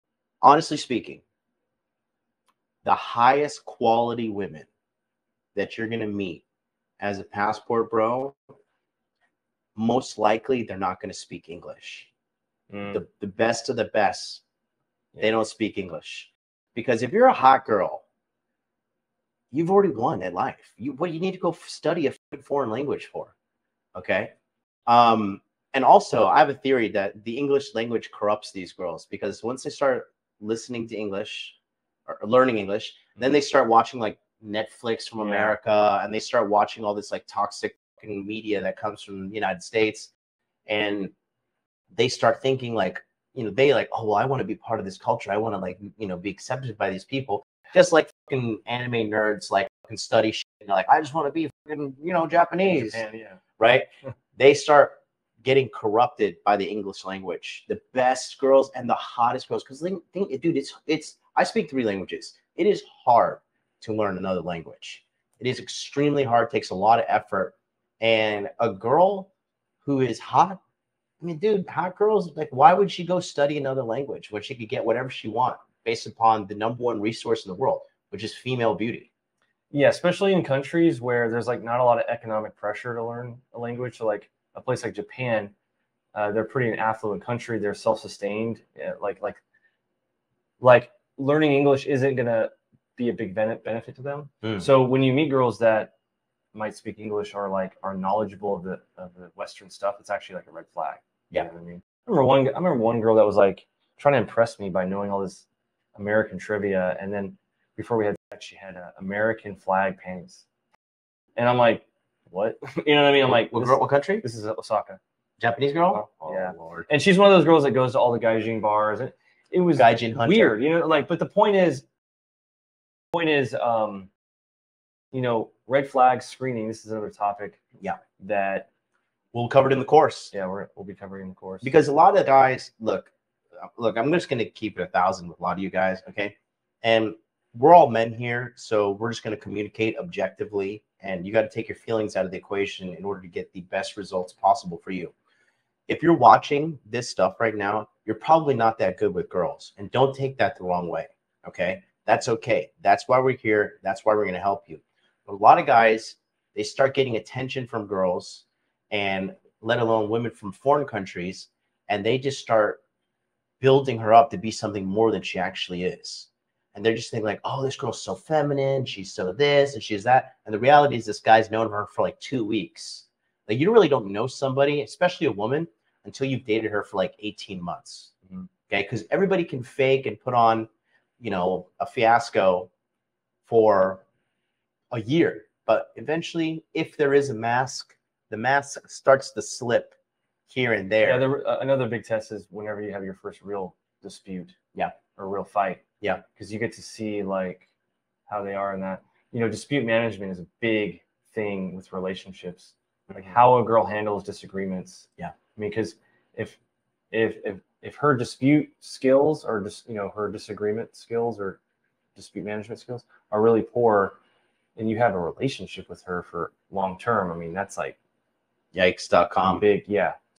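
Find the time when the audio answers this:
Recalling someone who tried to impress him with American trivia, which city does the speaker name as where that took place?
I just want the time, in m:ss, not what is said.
1:54.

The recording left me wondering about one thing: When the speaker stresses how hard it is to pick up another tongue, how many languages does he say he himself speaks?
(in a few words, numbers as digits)
3.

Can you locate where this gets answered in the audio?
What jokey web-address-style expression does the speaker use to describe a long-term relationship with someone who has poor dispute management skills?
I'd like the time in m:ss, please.
3:38.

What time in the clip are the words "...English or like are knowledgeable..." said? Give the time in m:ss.
1:36.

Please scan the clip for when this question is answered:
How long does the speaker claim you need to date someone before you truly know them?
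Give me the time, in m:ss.
2:57.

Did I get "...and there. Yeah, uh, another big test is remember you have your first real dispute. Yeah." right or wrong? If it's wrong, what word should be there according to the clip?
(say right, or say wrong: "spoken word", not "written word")
wrong: "whenever", not "remember".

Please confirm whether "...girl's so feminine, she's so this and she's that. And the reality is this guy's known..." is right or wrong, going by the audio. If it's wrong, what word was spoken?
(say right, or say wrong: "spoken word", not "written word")
right.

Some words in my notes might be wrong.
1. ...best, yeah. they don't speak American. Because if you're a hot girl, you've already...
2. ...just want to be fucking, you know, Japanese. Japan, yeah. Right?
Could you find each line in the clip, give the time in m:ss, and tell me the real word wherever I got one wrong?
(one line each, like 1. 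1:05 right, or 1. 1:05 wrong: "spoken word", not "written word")
1. 0:13 wrong: "English", not "American"
2. 0:50 right.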